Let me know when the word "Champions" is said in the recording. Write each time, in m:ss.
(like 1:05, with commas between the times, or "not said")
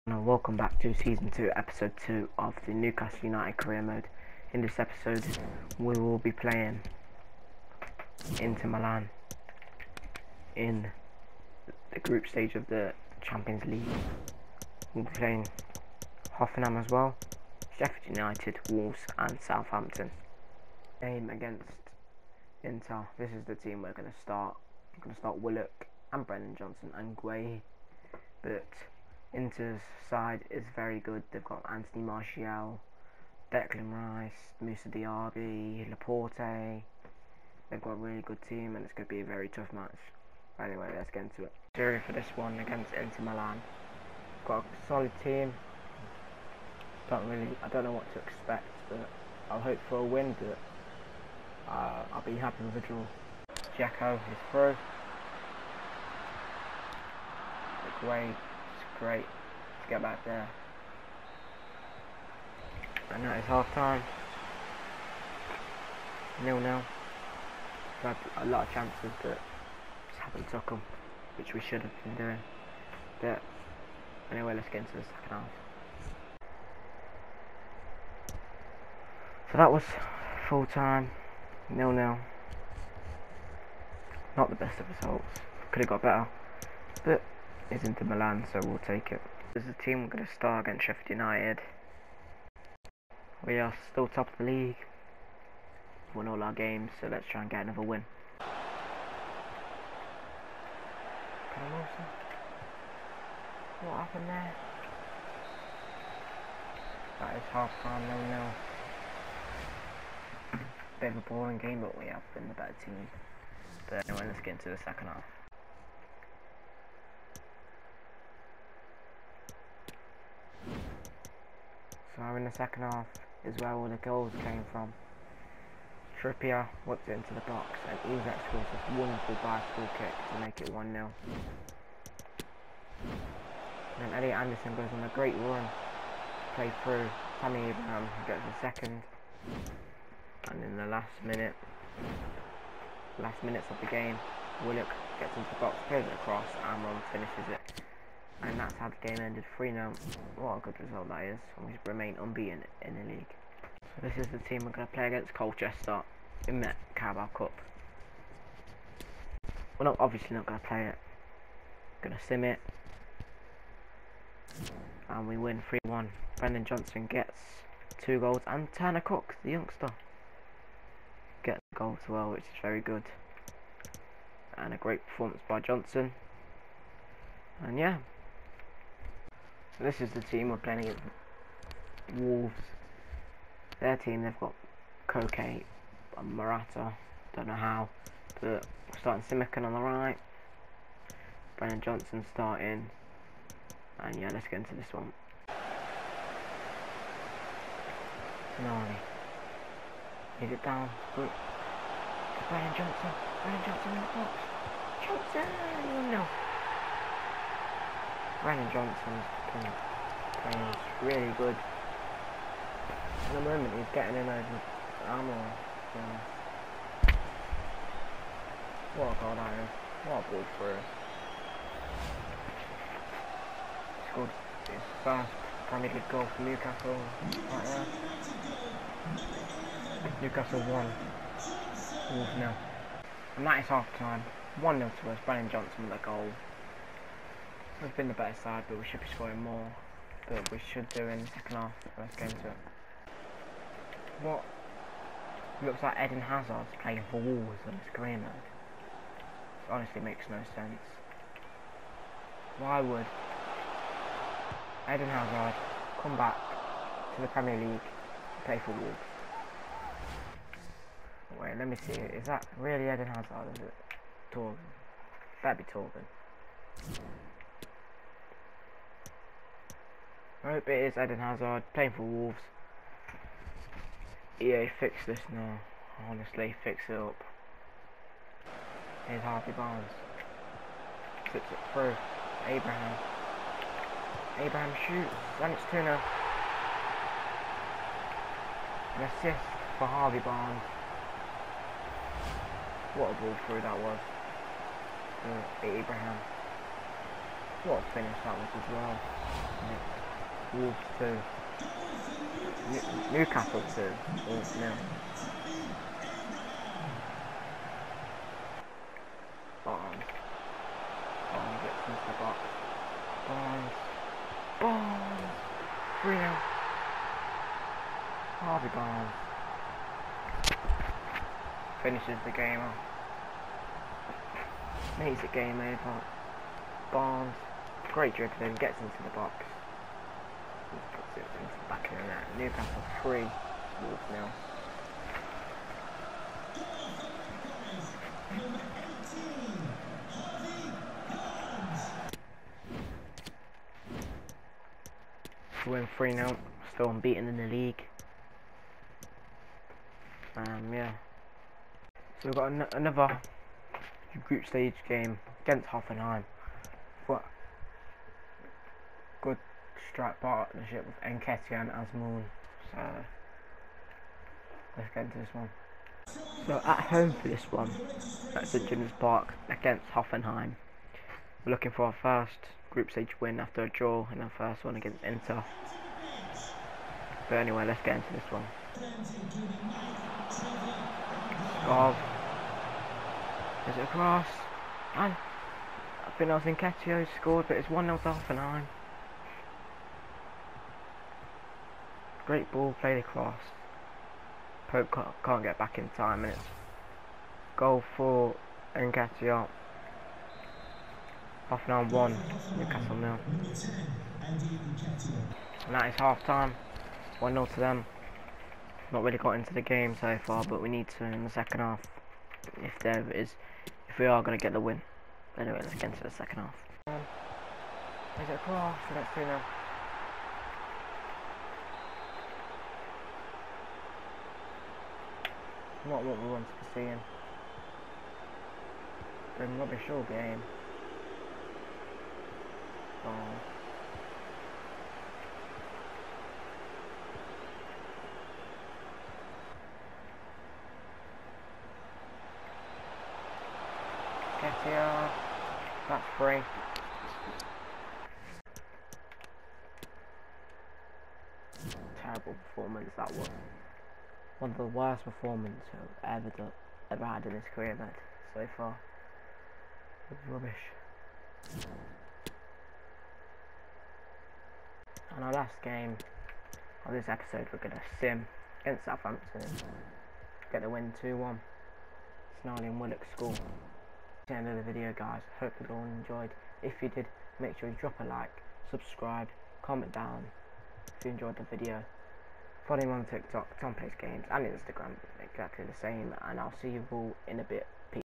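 0:13.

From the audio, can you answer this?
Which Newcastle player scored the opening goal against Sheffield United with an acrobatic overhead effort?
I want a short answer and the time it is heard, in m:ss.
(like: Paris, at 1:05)
Isak, at 2:08.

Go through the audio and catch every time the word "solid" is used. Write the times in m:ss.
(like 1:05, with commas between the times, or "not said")
0:44.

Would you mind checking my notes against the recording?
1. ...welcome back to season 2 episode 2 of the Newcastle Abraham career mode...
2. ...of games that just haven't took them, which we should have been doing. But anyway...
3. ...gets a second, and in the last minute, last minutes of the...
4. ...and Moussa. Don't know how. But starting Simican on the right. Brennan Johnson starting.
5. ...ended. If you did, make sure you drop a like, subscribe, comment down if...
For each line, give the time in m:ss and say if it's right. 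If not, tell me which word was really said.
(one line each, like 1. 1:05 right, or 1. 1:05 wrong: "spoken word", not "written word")
1. 0:00 wrong: "United", not "Abraham"
2. 1:08 wrong: "chances", not "games"
3. 2:18 right
4. 3:06 wrong: "Morata", not "Moussa"
5. 7:55 wrong: "enjoyed", not "ended".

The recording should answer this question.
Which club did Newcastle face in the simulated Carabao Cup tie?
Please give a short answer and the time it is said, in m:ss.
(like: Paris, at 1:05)
Colchester, at 2:35.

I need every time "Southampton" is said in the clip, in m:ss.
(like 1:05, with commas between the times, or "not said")
0:19, 7:48.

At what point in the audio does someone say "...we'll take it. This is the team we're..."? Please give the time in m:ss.
1:28.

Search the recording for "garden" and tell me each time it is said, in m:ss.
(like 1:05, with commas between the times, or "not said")
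not said.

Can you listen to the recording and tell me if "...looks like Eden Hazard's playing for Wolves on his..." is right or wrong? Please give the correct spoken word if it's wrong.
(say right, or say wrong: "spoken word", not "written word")
right.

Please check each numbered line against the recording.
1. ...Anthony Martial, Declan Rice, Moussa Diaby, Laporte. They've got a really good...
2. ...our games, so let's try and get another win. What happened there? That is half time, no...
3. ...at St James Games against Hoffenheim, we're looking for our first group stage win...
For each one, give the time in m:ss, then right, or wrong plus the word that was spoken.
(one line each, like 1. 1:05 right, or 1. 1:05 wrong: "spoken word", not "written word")
1. 0:31 right
2. 1:36 right
3. 6:08 wrong: "Park", not "Games".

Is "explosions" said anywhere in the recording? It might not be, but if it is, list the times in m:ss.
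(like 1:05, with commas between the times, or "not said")
not said.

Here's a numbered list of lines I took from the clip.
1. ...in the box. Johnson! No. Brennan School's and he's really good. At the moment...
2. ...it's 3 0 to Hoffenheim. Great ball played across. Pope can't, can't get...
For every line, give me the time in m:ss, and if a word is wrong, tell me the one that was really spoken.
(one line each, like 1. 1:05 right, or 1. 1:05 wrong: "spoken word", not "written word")
1. 3:23 wrong: "Johnson", not "School"
2. 6:27 wrong: "1", not "3".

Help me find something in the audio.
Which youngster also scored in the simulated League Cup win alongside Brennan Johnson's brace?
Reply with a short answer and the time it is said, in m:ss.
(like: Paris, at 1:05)
Tanner Cook, at 2:48.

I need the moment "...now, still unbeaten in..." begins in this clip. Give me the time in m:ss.
5:46.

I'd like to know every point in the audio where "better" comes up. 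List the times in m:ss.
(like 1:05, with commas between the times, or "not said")
1:26, 1:52, 3:58.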